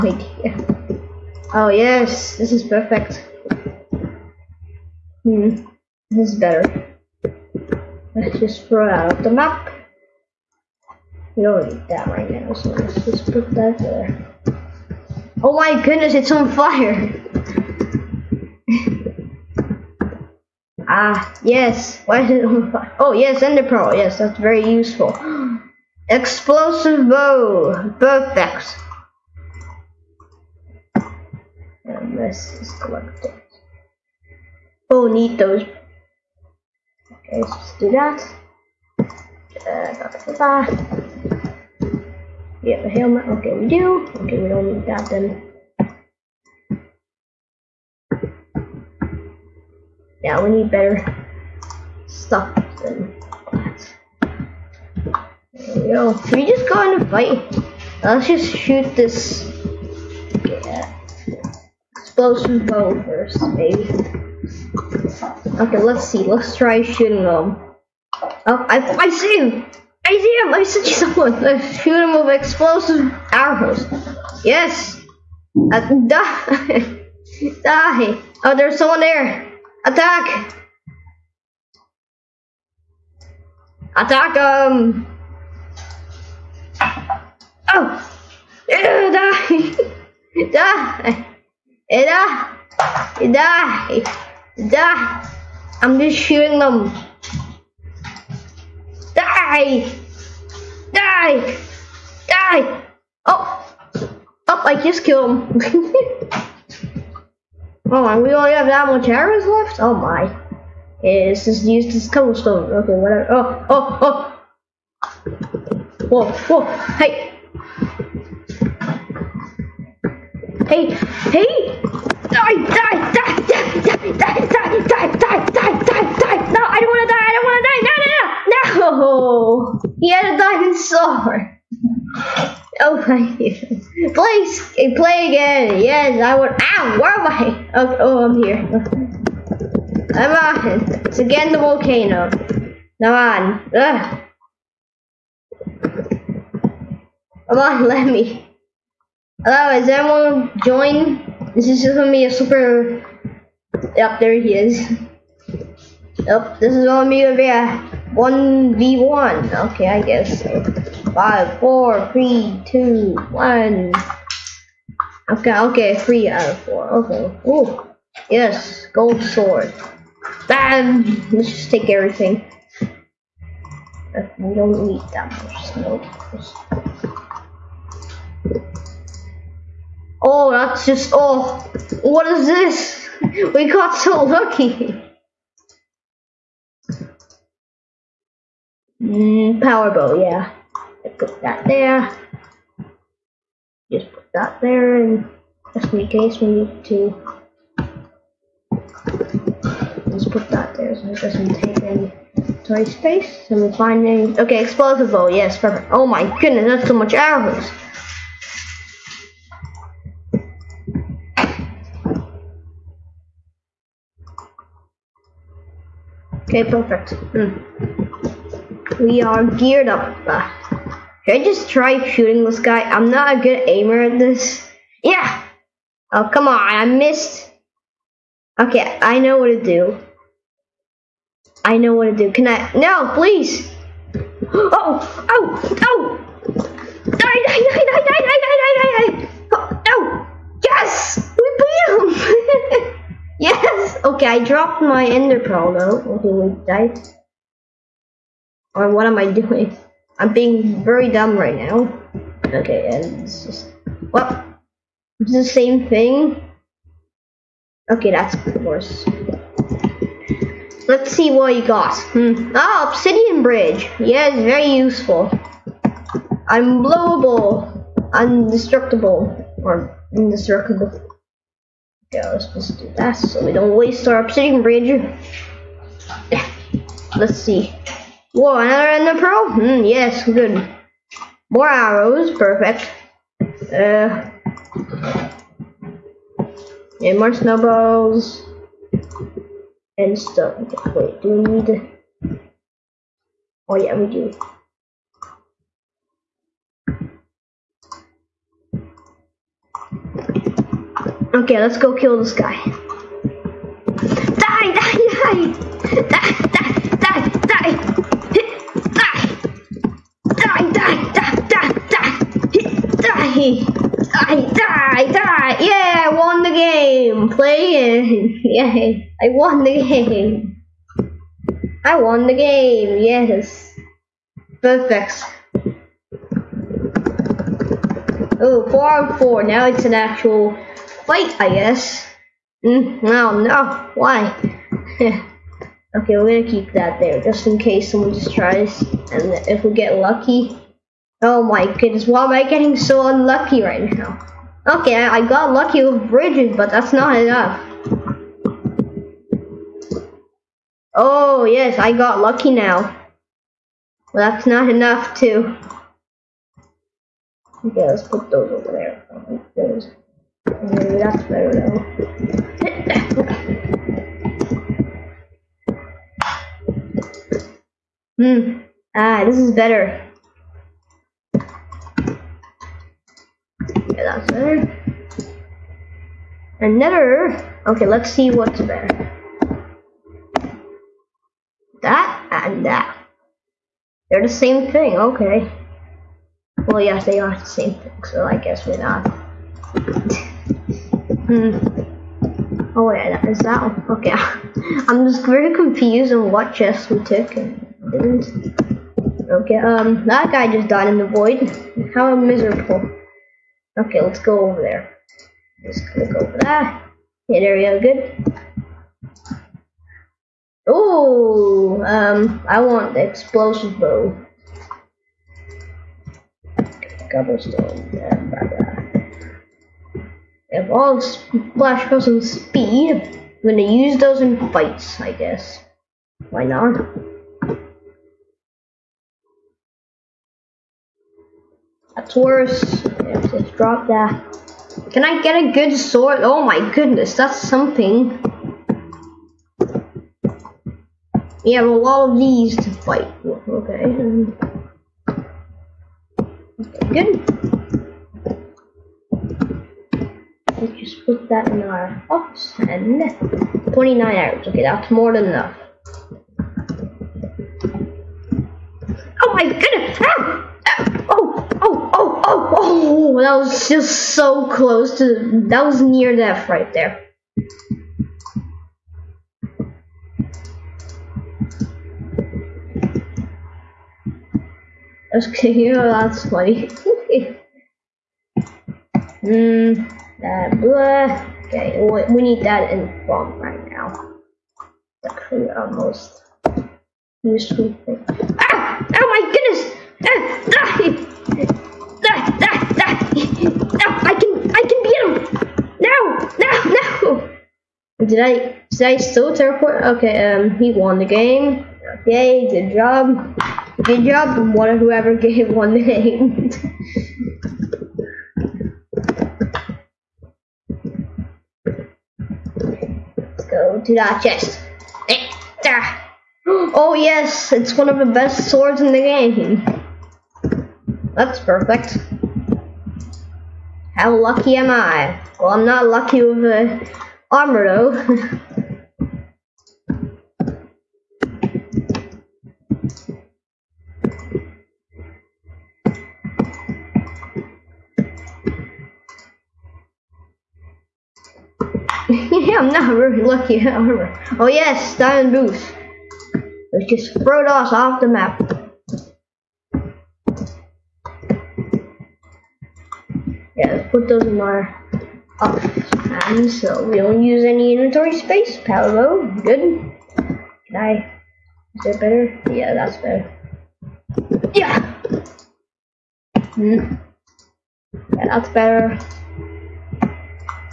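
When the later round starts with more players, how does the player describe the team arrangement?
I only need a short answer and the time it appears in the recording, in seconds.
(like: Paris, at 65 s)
Four on four, at 328 s.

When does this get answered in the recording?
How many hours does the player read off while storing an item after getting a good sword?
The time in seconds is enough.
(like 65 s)
453 s.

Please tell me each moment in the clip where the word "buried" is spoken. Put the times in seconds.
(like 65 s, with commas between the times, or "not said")
not said.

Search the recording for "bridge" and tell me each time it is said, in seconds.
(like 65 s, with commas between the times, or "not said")
263 s, 274 s, 346 s.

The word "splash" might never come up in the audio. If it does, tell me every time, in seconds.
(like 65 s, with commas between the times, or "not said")
420 s.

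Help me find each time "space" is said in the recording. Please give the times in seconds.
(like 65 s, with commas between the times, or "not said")
202 s, 558 s.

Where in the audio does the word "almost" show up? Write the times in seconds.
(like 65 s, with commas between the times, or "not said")
485 s.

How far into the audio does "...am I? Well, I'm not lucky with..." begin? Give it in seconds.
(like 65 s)
524 s.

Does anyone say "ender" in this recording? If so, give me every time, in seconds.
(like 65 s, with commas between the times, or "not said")
23 s, 245 s, 278 s.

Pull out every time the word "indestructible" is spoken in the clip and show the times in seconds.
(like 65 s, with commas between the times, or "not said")
270 s.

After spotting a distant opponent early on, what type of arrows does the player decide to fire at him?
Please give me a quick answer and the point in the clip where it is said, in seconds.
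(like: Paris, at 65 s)
Explosive arrows, at 72 s.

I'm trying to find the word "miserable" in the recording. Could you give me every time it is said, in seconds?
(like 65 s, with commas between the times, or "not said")
402 s.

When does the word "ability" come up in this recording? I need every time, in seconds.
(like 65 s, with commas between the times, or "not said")
not said.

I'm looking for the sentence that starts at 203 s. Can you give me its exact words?
So we find finding, okay, explosive bow, yes, perfect.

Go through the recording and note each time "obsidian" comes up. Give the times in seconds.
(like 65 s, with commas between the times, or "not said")
262 s, 274 s.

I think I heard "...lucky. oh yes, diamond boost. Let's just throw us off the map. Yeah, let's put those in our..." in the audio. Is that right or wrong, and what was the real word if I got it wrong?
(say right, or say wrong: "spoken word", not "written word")
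right.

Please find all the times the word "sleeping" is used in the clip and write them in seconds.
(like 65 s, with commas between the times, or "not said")
not said.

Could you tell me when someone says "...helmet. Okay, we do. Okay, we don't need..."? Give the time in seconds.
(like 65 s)
42 s.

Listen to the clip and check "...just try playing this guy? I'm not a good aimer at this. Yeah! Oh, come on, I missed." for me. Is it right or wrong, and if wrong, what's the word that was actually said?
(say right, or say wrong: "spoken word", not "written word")
wrong: "shooting", not "playing".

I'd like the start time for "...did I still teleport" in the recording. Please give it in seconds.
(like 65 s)
498 s.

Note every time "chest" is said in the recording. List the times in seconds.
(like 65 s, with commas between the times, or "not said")
396 s, 514 s.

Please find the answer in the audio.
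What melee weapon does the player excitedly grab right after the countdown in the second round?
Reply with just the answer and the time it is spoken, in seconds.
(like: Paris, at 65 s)
Gold sword, at 168 s.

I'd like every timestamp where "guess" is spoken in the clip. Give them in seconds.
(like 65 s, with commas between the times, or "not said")
160 s, 331 s, 388 s, 425 s.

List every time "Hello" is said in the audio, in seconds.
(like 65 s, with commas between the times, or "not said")
149 s.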